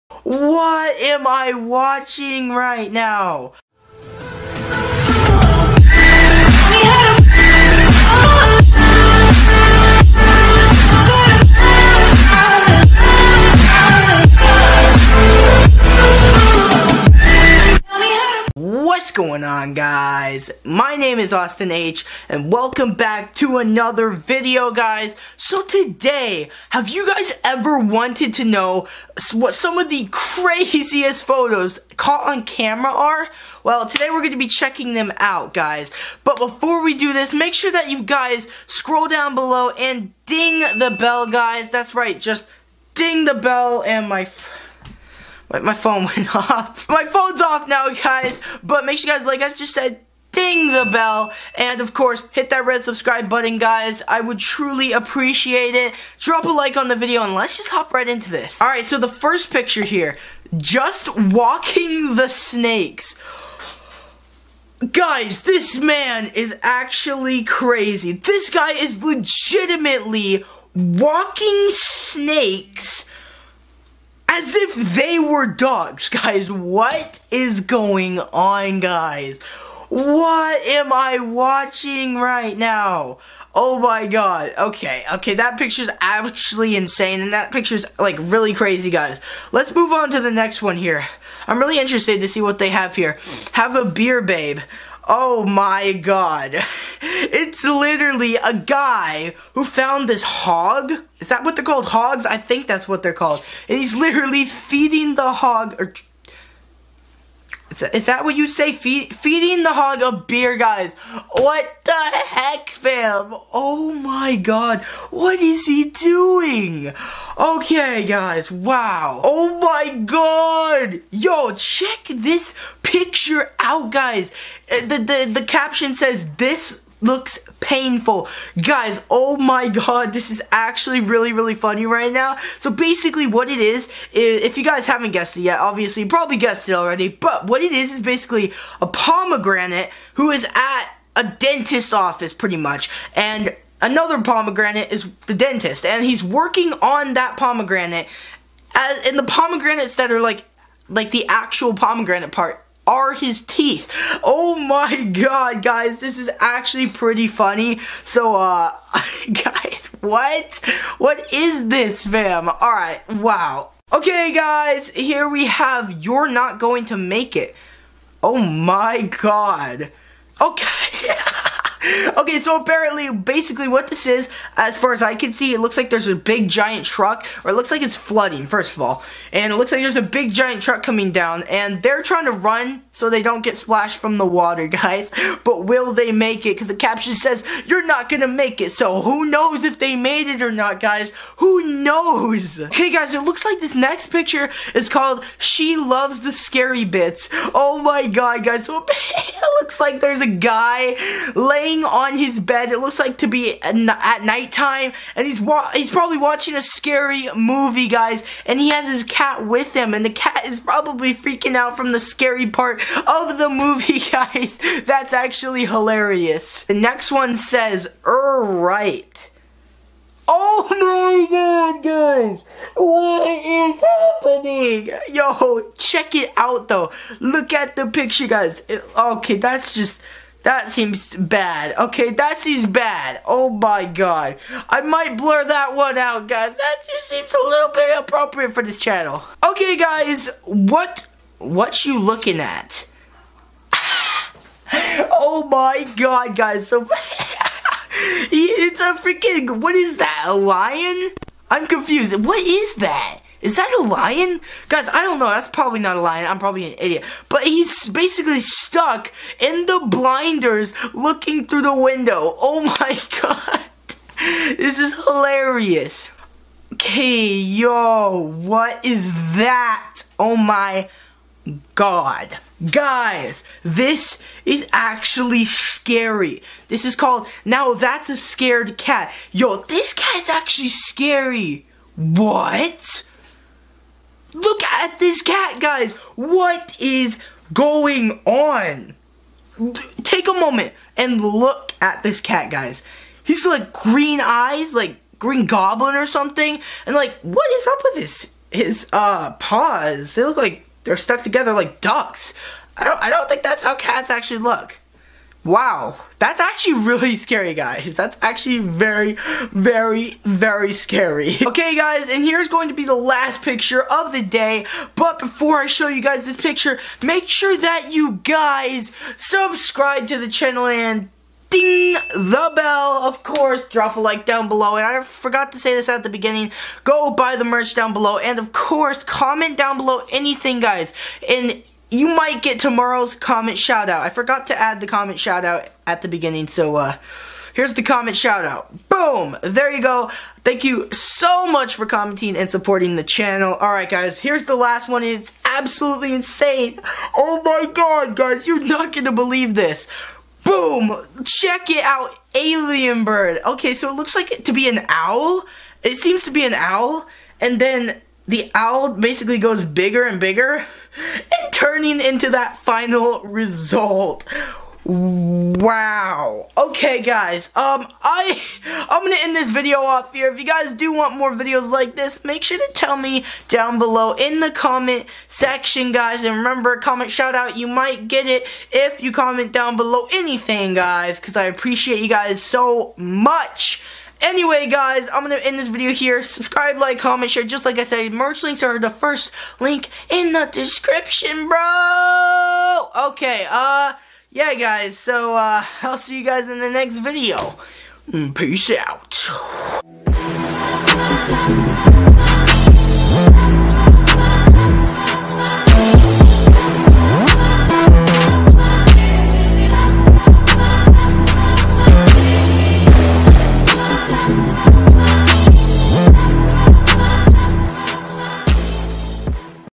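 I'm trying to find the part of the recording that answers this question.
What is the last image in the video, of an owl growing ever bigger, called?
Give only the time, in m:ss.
5:52.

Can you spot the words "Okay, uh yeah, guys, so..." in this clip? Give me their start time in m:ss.
6:32.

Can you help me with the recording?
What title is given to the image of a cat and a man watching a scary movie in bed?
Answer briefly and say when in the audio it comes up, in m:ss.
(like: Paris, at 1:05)
She Loves the Scary Bits, at 3:15.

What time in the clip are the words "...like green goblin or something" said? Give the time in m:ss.
4:54.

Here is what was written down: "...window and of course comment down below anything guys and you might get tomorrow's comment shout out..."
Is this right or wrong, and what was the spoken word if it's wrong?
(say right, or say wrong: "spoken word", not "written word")
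wrong: "below", not "window".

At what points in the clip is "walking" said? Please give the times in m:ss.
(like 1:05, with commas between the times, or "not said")
1:01, 1:10.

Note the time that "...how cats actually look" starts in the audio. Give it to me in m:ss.
5:03.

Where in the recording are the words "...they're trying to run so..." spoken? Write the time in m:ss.
3:01.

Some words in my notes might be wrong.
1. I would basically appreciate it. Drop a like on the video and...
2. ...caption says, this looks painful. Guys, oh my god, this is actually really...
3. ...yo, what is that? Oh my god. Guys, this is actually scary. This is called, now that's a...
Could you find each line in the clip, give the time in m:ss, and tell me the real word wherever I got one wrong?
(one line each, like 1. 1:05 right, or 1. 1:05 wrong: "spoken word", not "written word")
1. 0:54 wrong: "truly", not "basically"
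2. 2:05 right
3. 4:27 right.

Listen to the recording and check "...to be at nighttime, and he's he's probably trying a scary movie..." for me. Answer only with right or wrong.
wrong.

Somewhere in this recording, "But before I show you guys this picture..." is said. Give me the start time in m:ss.
5:14.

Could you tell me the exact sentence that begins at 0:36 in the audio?
But before we do this, make sure that you guys scroll down below and ding the bell guys.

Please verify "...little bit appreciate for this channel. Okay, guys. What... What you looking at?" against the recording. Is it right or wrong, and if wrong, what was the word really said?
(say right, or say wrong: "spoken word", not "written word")
wrong: "inappropriate", not "appreciate".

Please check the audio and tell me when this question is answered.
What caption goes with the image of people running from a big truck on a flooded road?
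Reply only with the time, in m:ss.
2:46.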